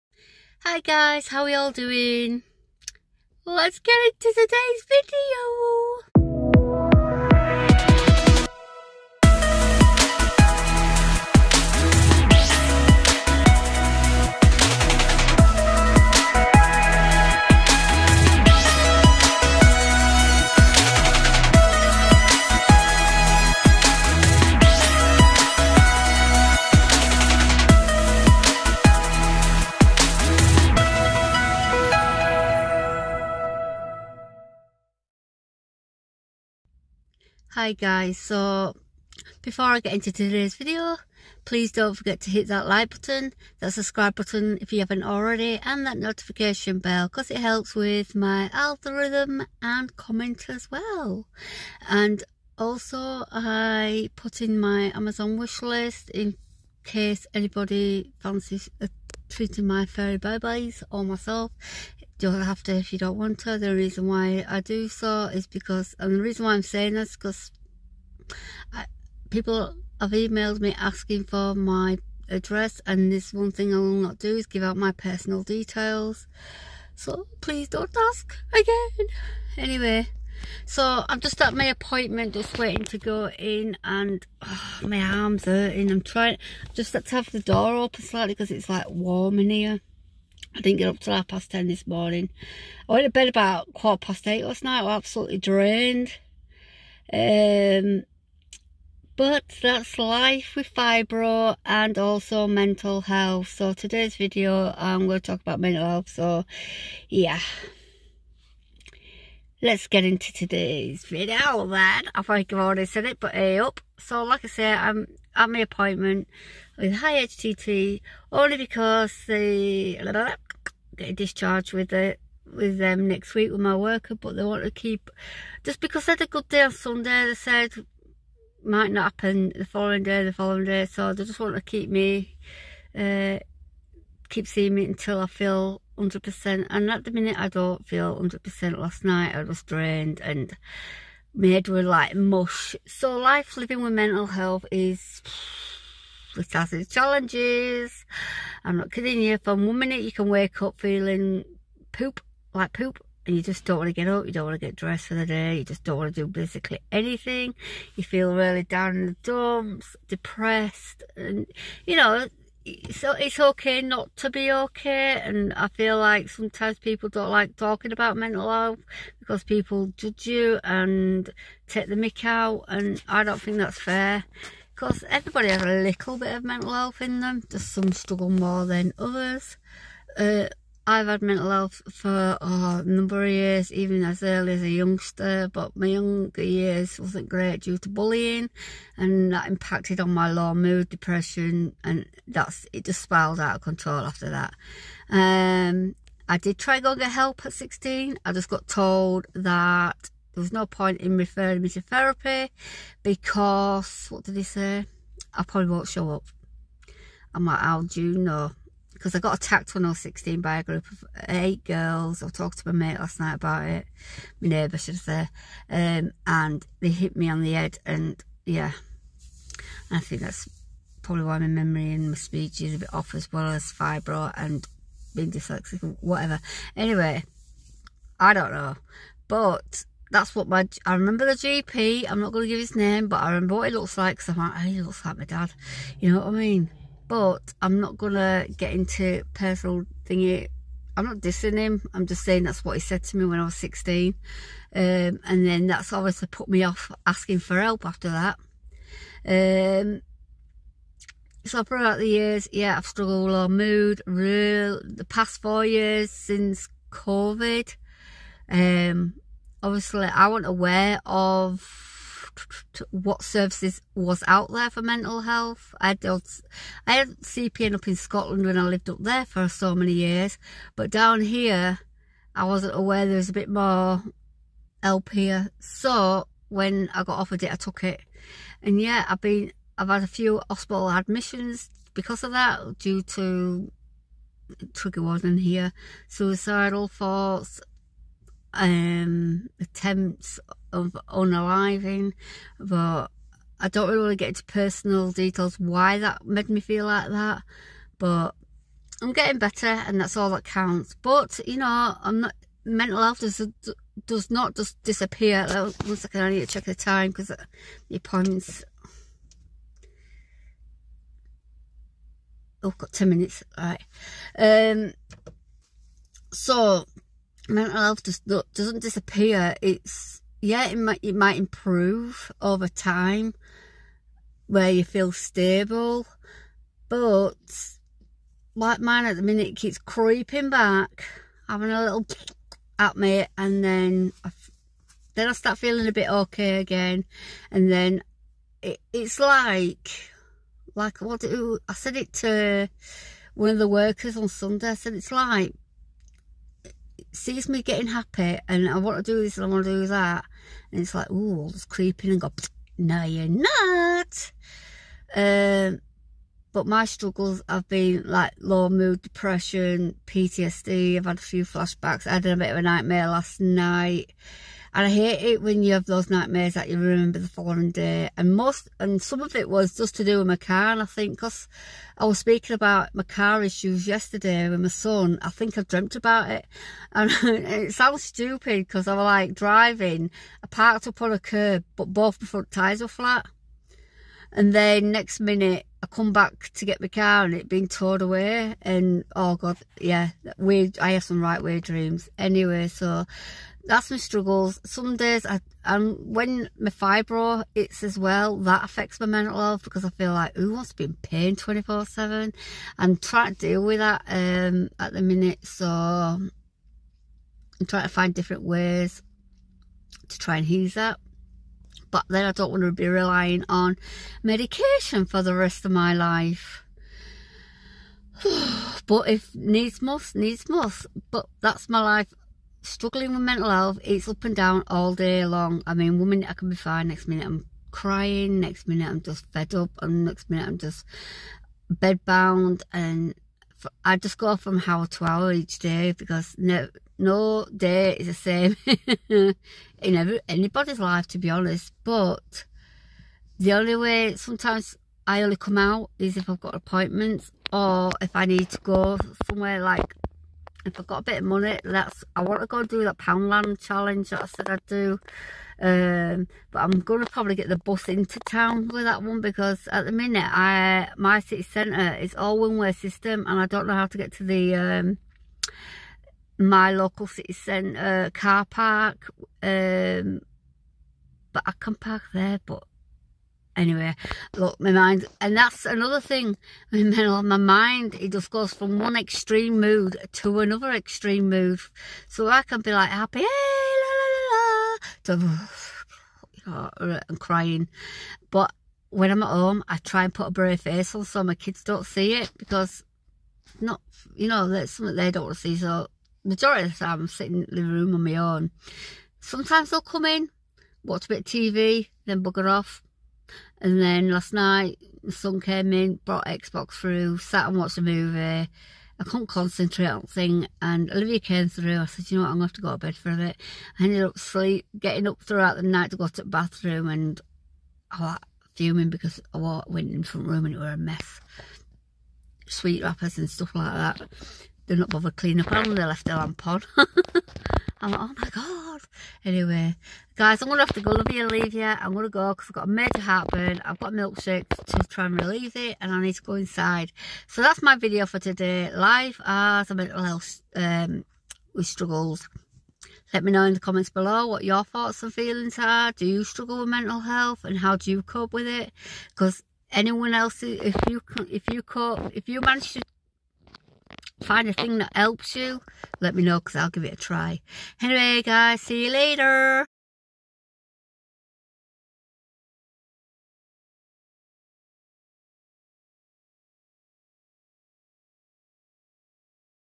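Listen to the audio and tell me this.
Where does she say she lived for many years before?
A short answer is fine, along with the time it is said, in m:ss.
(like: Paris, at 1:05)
Scotland, at 4:27.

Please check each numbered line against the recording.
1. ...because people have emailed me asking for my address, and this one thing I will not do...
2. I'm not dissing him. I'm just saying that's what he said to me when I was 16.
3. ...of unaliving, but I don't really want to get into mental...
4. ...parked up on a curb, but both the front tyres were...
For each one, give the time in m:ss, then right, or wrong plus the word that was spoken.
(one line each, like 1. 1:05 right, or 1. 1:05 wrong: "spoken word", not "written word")
1. 1:07 right
2. 4:00 right
3. 4:50 wrong: "personal", not "mental"
4. 6:20 right.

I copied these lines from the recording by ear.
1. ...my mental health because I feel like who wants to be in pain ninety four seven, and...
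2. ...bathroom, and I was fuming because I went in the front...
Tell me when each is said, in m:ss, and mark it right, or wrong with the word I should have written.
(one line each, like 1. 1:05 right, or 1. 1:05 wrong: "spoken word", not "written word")
1. 6:38 wrong: "twenty", not "ninety"
2. 8:36 right.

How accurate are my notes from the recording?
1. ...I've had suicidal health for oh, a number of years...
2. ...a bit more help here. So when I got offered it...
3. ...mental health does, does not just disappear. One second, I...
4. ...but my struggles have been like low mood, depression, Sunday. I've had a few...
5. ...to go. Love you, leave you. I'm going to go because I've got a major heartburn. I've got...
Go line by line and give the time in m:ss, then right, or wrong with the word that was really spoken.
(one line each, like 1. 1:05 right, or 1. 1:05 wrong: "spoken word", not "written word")
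1. 3:00 wrong: "mental", not "suicidal"
2. 4:33 right
3. 5:02 right
4. 5:56 wrong: "PTSD", not "Sunday"
5. 8:50 right.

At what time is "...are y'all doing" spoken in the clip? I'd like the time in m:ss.
0:01.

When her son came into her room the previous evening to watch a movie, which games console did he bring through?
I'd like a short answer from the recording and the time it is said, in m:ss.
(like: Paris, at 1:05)
Xbox, at 8:26.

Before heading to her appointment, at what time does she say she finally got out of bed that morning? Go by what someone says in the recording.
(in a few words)
Half past ten.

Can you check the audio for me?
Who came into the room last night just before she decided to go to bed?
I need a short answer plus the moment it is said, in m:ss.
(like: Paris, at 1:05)
Olivia, at 8:30.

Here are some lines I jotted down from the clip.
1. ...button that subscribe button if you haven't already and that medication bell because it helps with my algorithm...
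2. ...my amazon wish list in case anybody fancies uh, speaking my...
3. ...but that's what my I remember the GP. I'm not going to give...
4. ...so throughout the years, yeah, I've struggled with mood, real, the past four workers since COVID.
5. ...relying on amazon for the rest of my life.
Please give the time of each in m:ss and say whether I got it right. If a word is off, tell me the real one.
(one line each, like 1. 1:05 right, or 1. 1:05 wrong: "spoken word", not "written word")
1. 0:42 wrong: "notification", not "medication"
2. 0:54 wrong: "treating", not "speaking"
3. 3:49 right
4. 4:11 wrong: "years", not "workers"
5. 6:52 wrong: "medication", not "amazon".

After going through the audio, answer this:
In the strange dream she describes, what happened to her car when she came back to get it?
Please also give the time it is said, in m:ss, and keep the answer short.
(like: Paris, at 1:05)
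Towed away, at 6:27.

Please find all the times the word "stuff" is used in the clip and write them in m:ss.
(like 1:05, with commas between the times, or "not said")
8:43.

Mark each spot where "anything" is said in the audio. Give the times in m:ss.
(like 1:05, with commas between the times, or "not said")
2:36.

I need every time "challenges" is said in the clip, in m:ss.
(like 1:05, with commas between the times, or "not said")
2:26, 7:33.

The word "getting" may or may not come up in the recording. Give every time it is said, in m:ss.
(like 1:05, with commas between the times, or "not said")
4:59, 5:47, 8:34.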